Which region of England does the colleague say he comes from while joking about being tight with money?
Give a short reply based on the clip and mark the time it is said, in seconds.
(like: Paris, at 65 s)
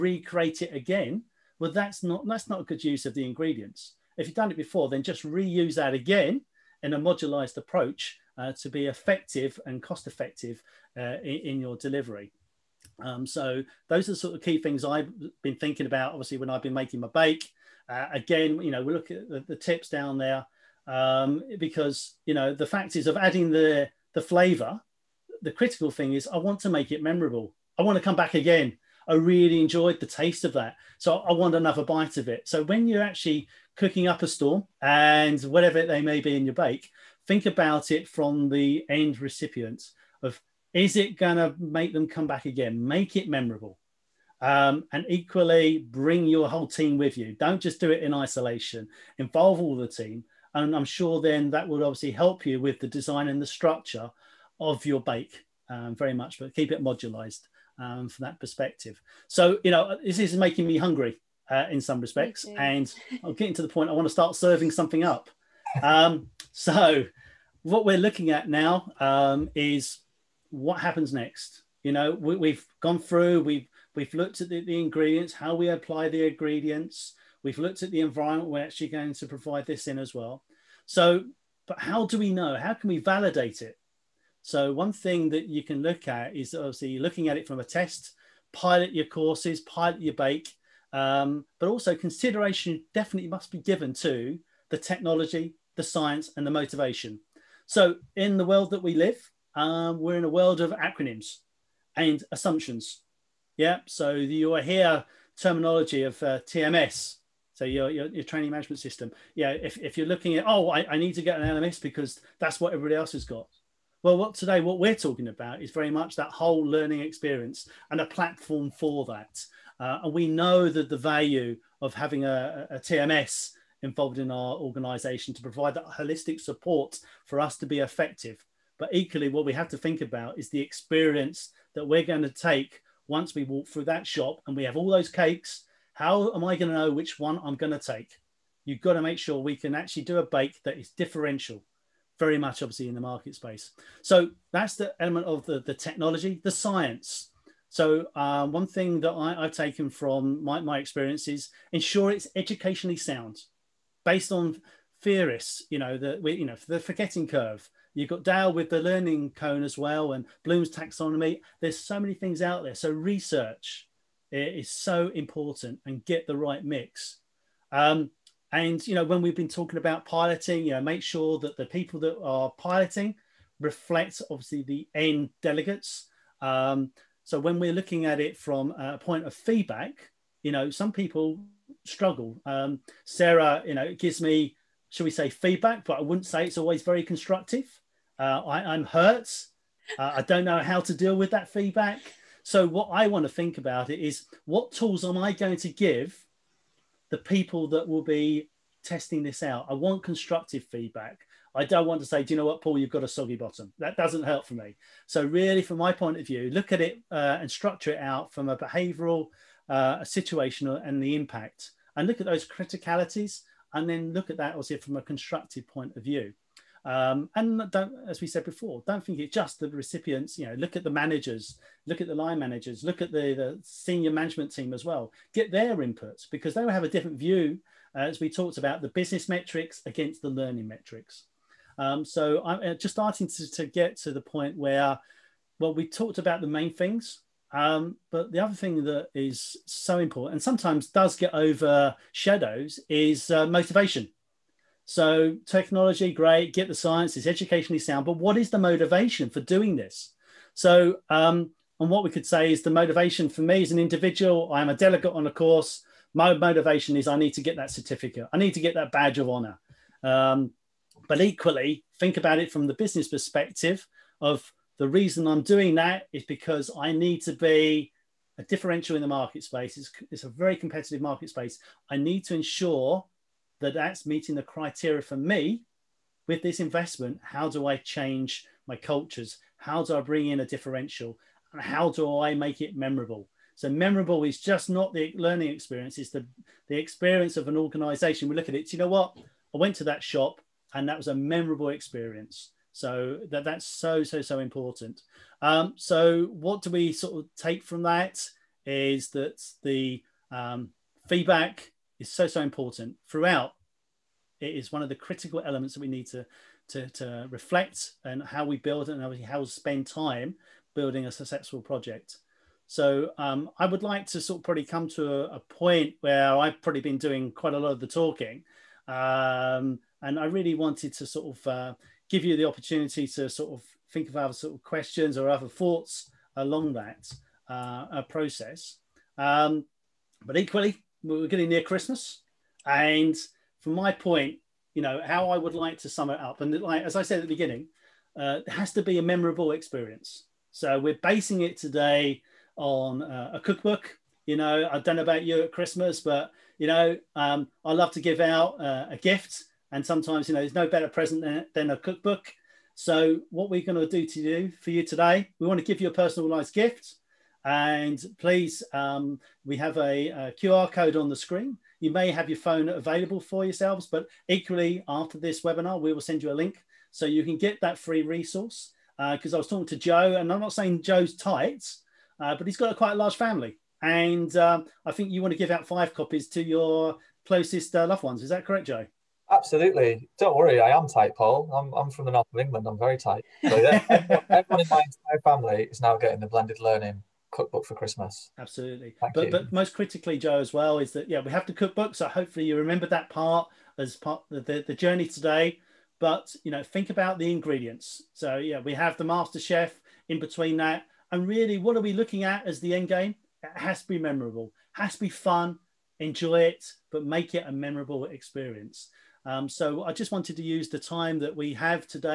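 north of England, at 382 s.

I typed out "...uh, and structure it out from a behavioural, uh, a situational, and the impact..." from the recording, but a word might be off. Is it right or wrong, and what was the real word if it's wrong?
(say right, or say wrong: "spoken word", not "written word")
right.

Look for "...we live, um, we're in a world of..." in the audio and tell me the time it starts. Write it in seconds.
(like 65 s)
98 s.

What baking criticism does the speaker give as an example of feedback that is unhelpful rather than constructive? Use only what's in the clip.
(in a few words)
soggy bottom.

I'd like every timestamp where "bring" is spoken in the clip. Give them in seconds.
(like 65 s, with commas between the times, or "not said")
45 s, 280 s.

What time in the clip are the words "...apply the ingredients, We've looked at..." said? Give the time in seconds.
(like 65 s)
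75 s.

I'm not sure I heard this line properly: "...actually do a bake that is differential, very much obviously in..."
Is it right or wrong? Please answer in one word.
right.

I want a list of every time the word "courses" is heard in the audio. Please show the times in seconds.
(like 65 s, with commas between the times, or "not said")
89 s, 255 s.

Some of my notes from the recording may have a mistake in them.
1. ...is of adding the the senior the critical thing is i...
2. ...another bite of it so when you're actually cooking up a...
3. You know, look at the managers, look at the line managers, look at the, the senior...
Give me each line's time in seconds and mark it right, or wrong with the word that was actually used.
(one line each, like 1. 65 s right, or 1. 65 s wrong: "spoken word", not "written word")
1. 22 s wrong: "flavor", not "senior"
2. 31 s right
3. 220 s right.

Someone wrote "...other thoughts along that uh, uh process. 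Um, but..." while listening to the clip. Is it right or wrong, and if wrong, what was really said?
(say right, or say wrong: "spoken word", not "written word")
right.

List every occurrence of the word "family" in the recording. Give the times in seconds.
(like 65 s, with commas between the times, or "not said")
373 s, 385 s.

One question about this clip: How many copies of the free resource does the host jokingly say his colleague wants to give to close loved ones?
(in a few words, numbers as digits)
5.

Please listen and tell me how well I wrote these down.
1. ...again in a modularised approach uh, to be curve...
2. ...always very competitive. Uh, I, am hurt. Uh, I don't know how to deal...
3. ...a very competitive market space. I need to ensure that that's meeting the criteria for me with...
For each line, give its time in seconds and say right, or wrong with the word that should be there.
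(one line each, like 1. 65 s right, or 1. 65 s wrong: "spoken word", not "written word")
1. 5 s wrong: "effective", not "curve"
2. 186 s wrong: "constructive", not "competitive"
3. 270 s right.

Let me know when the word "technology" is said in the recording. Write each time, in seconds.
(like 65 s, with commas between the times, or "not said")
94 s, 145 s, 245 s.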